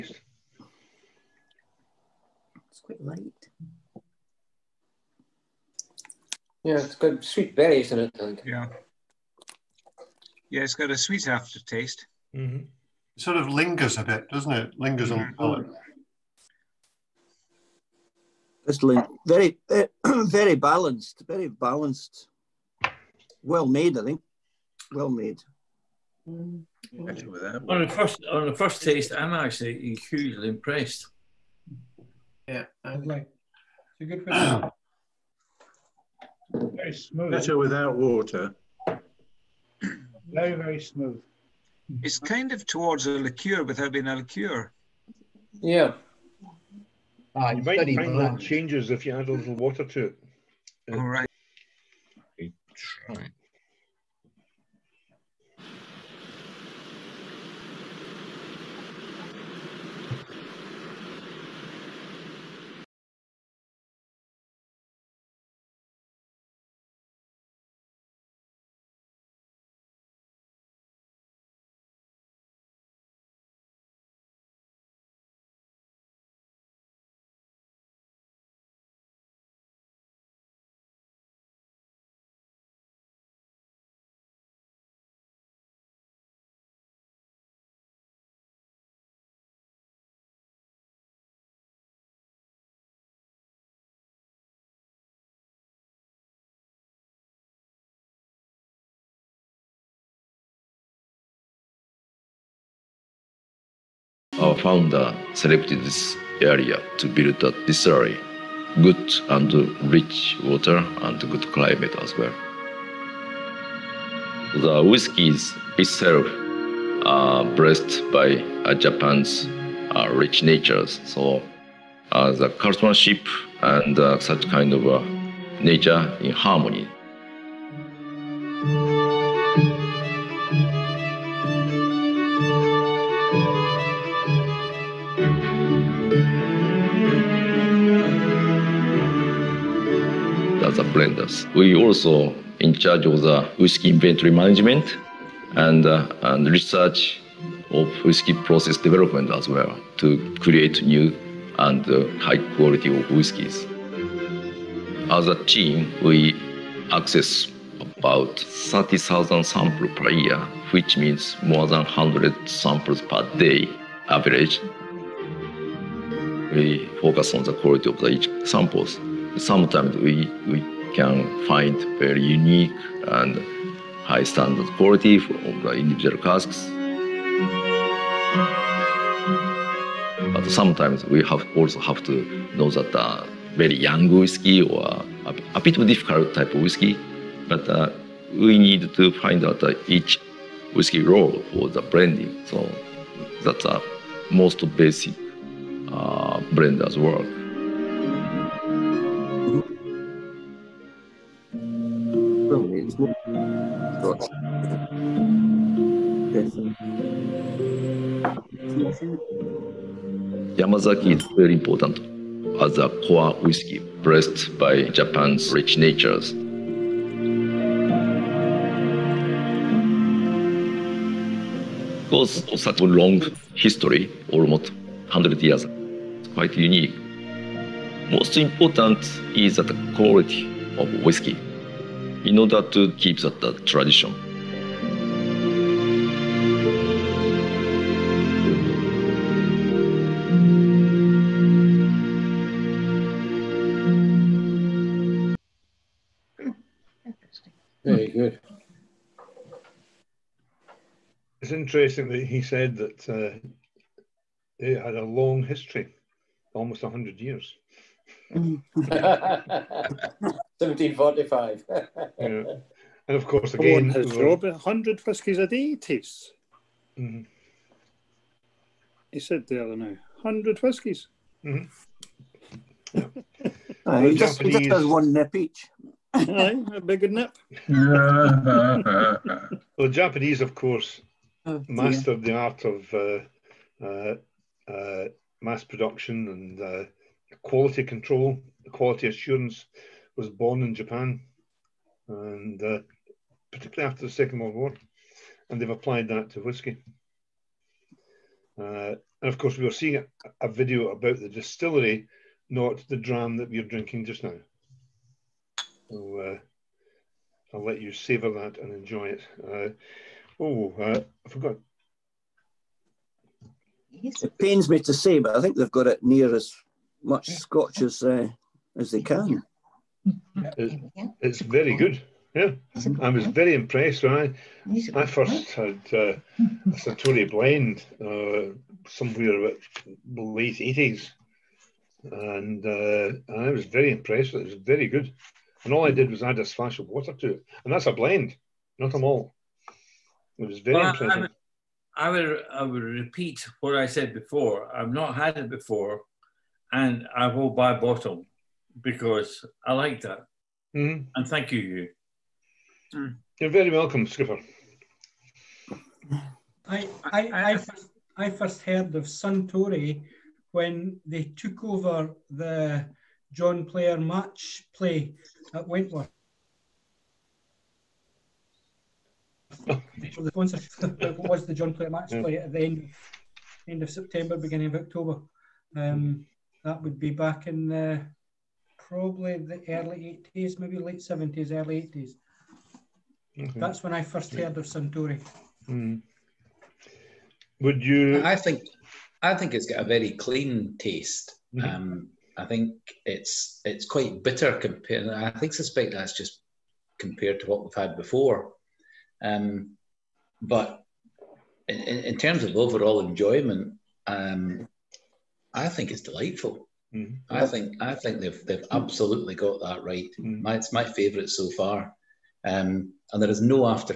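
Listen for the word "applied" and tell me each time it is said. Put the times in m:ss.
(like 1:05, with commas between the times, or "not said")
4:55.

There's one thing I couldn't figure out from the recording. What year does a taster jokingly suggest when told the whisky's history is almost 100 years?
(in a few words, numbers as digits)
1745.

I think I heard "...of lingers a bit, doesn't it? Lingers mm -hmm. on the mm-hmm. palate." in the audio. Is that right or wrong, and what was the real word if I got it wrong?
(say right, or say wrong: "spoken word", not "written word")
right.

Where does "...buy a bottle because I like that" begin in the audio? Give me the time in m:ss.
5:47.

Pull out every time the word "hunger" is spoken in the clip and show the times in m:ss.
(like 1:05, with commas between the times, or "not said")
not said.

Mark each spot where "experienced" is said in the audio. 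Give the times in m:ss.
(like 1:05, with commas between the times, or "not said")
not said.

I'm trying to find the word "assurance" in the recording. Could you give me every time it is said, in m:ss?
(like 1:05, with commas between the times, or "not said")
4:49.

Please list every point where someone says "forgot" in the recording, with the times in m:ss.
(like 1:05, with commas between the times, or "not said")
5:11.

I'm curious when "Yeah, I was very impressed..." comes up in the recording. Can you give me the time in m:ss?
5:22.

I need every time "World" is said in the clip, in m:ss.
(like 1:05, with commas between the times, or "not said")
4:54.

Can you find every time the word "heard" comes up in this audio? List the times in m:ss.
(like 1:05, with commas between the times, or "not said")
5:58, 6:24.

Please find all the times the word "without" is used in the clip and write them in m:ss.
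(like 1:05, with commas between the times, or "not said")
0:37, 0:43.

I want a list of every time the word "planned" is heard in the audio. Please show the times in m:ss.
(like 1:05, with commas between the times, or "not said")
not said.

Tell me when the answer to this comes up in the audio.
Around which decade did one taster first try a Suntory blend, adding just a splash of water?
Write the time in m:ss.
5:30.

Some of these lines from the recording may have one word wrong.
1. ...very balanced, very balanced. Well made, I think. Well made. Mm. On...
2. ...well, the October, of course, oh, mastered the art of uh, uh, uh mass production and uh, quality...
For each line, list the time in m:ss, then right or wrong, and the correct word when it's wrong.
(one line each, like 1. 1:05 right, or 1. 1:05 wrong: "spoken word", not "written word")
1. 0:20 right
2. 4:37 wrong: "Japanese", not "October".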